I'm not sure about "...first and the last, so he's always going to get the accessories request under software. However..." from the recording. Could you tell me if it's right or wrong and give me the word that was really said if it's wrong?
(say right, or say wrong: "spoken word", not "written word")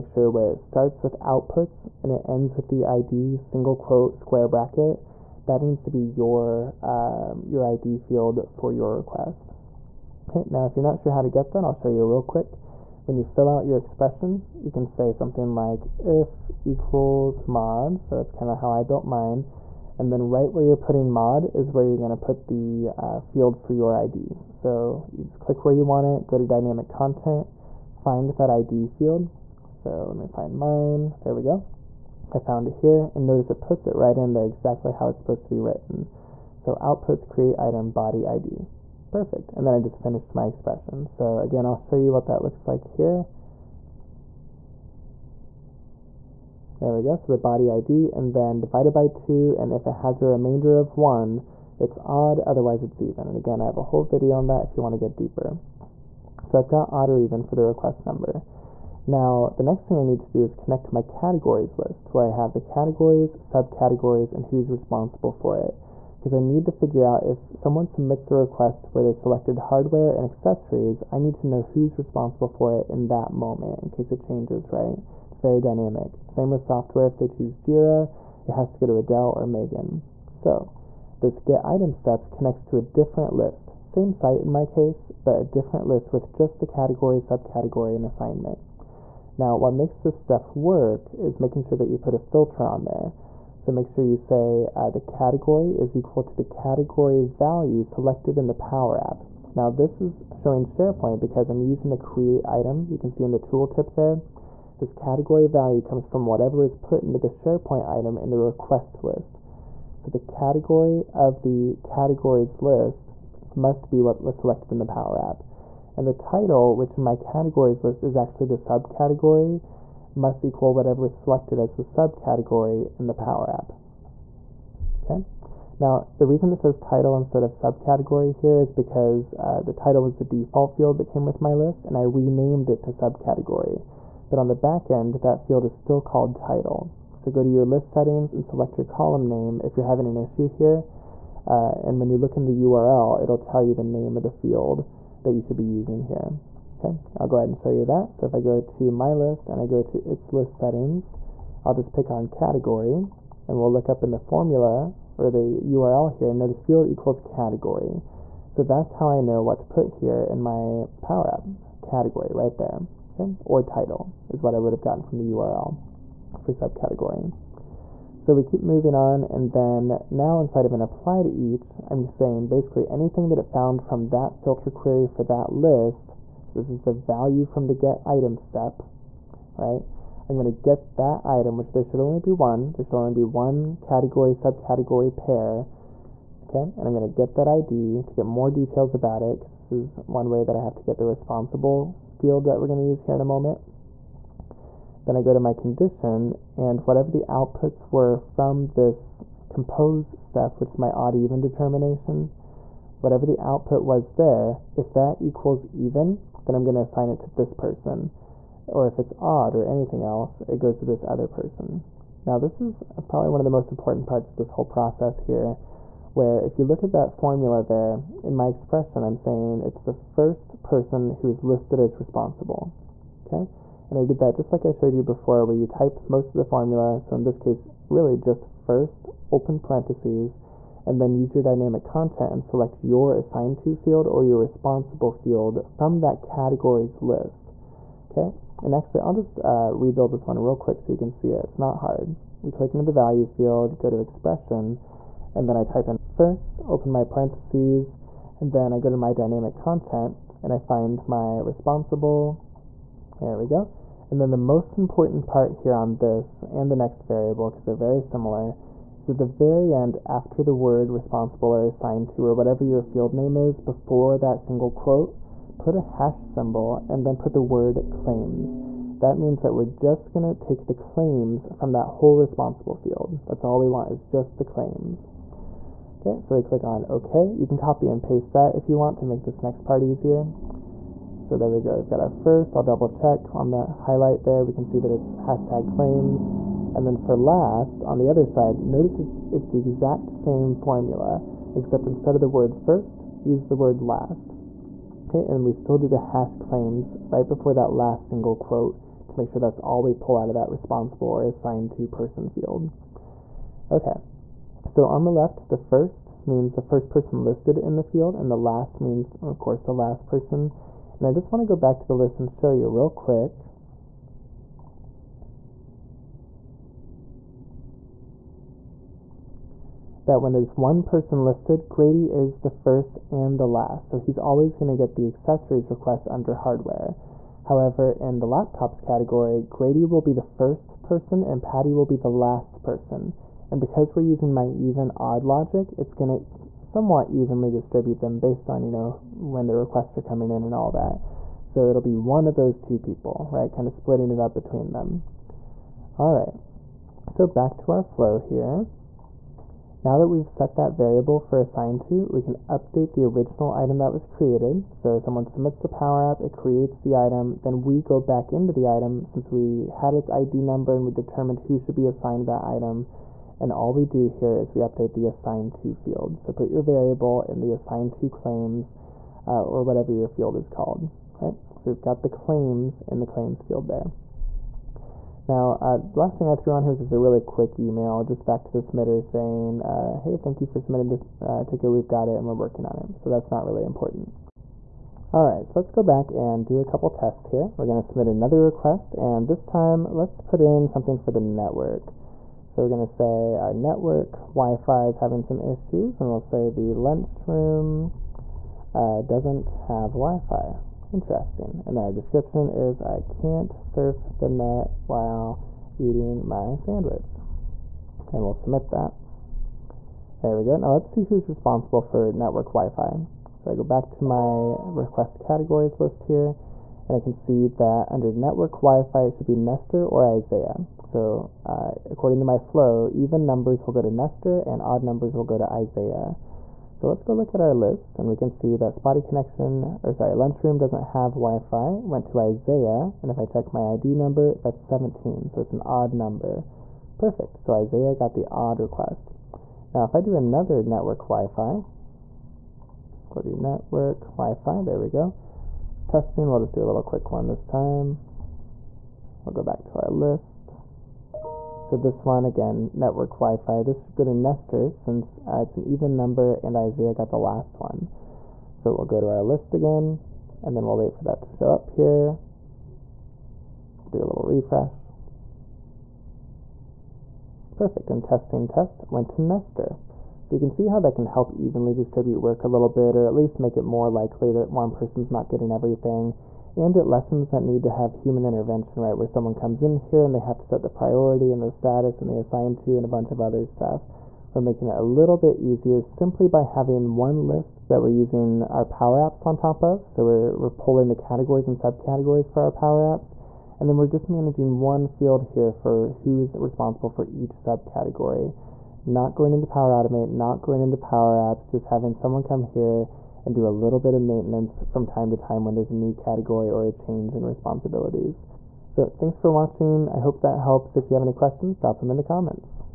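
wrong: "hardware", not "software".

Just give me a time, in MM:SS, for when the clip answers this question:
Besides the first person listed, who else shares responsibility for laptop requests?
05:31.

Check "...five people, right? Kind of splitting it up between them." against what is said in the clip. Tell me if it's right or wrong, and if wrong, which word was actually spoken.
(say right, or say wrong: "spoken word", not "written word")
wrong: "two", not "five".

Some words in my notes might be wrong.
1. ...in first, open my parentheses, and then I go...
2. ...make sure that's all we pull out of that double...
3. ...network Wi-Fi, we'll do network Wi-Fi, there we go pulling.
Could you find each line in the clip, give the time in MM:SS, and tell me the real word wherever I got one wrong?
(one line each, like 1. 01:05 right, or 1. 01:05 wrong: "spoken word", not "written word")
1. 04:05 right
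2. 04:59 wrong: "responsible", not "double"
3. 07:20 wrong: "testing", not "pulling".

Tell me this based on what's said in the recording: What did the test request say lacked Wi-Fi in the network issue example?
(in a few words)
the lunchroom.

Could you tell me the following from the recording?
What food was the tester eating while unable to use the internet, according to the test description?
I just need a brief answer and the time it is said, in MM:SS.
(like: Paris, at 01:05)
sandwich, at 06:45.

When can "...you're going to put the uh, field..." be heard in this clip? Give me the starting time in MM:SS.
00:21.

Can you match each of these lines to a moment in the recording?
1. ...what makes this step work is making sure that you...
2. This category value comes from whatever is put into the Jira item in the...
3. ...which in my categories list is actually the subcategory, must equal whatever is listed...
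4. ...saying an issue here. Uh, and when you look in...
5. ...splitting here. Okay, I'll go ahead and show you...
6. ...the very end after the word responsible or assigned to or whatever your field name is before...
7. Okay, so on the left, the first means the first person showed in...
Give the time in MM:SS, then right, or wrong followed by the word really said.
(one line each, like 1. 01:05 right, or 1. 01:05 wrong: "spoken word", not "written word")
1. 01:29 right
2. 01:44 wrong: "SharePoint", not "Jira"
3. 01:56 wrong: "selected", not "listed"
4. 02:19 wrong: "having", not "saying"
5. 02:25 wrong: "using", not "splitting"
6. 04:19 right
7. 05:03 wrong: "listed", not "showed".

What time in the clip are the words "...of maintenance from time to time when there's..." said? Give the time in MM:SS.
08:23.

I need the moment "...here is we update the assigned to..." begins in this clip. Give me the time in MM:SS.
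06:04.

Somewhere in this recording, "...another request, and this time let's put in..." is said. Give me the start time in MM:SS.
06:28.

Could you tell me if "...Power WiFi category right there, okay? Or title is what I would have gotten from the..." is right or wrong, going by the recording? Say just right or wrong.
wrong.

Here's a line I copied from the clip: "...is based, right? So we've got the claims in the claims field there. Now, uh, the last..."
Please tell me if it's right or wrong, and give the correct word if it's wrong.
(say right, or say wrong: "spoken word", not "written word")
wrong: "called", not "based".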